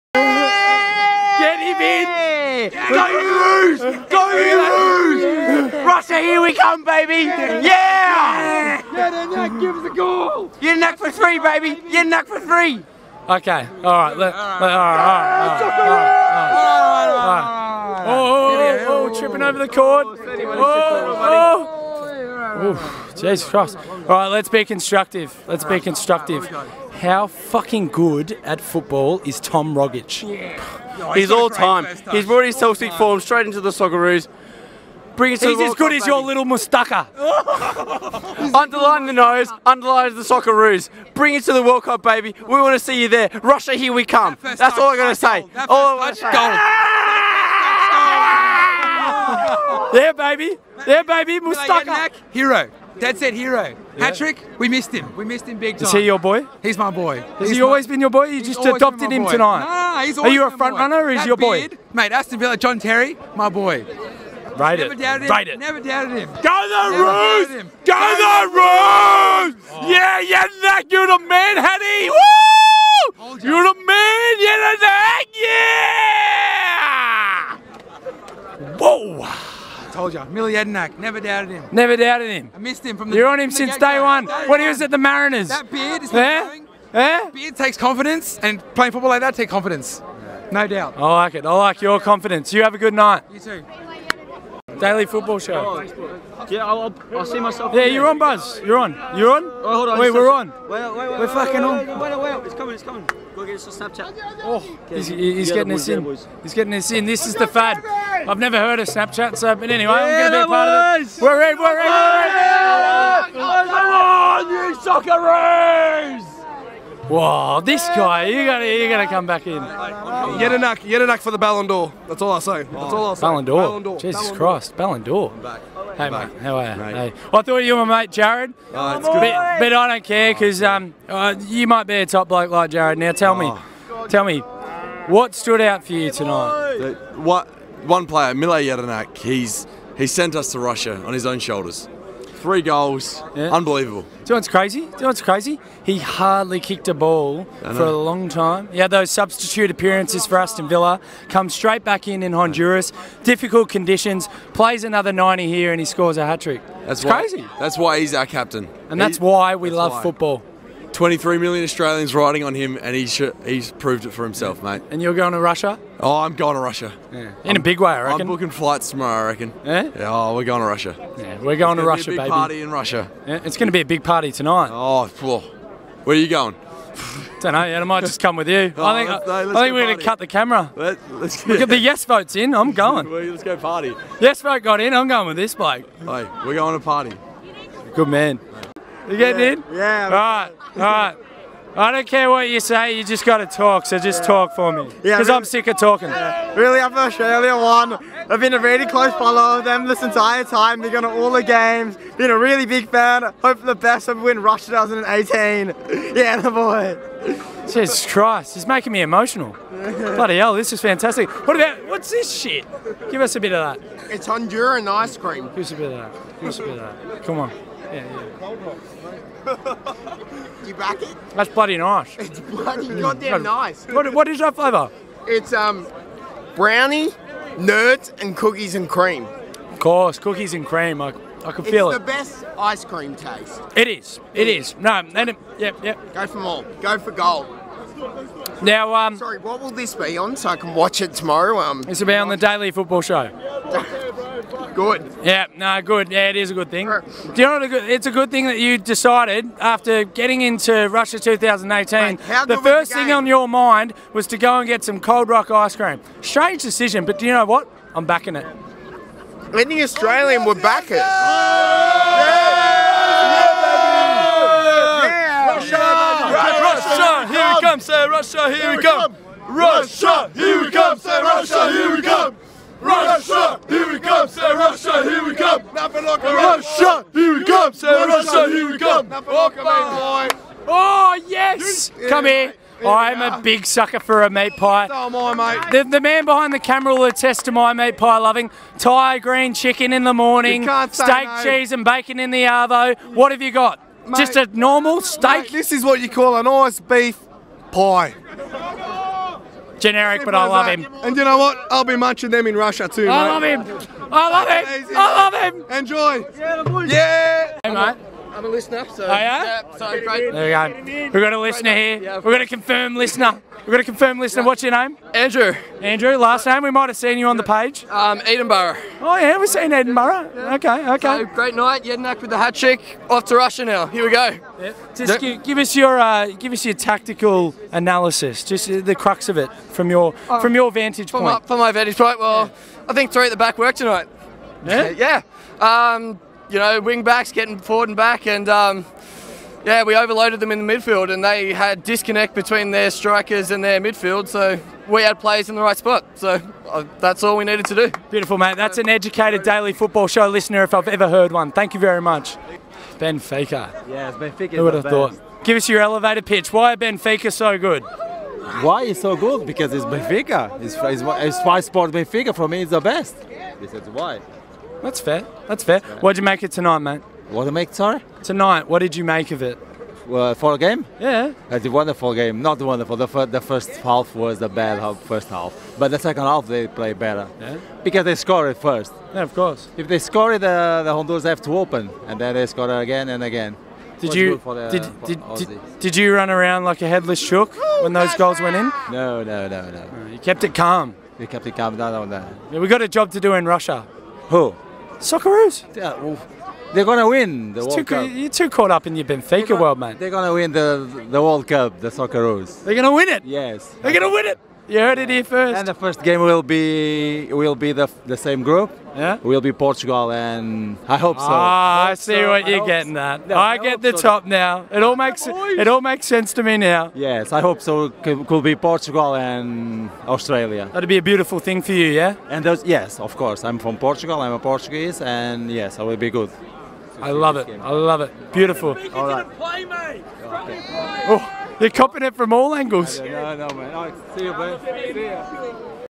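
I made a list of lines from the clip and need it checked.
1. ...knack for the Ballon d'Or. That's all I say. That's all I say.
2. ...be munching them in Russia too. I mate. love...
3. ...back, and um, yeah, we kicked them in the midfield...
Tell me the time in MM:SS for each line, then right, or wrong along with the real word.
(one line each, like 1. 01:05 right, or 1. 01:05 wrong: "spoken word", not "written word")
1. 02:01 right
2. 05:01 right
3. 05:37 wrong: "overloaded", not "kicked".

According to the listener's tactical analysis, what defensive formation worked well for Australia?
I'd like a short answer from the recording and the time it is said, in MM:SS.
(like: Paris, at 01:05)
three at the back, at 05:33.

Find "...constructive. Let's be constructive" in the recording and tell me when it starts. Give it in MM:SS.
00:24.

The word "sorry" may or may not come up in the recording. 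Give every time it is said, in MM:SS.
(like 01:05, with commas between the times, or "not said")
03:59, 06:07.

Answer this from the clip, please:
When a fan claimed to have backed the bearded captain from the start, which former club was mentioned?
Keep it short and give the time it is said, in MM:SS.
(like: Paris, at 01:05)
Mariners, at 01:24.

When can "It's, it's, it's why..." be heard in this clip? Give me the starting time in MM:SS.
06:00.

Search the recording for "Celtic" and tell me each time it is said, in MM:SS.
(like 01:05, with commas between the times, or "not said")
00:32.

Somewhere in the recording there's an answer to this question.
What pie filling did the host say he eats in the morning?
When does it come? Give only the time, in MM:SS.
04:48.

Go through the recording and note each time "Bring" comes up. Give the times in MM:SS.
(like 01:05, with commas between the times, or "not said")
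00:35, 00:41.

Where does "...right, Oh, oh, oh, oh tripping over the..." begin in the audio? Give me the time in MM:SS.
00:14.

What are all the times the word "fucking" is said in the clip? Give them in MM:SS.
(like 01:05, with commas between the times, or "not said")
00:27, 01:41.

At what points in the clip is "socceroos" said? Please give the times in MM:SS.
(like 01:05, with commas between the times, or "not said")
00:33, 00:40, 01:54, 06:35, 06:41.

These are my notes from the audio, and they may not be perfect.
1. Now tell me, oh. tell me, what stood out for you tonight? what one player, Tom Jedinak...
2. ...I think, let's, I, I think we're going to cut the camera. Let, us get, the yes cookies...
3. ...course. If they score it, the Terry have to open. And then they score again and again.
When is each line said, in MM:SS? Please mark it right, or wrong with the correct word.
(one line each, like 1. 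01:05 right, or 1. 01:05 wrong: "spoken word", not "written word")
1. 02:12 wrong: "Mile", not "Tom"
2. 02:58 wrong: "votes", not "cookies"
3. 06:19 wrong: "Honduras", not "Terry".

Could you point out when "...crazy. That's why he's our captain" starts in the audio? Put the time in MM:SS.
02:37.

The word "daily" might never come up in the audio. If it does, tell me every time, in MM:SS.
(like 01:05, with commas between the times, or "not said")
01:34, 04:02, 05:49.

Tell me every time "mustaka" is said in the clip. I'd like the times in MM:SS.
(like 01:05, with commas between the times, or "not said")
00:36, 00:51.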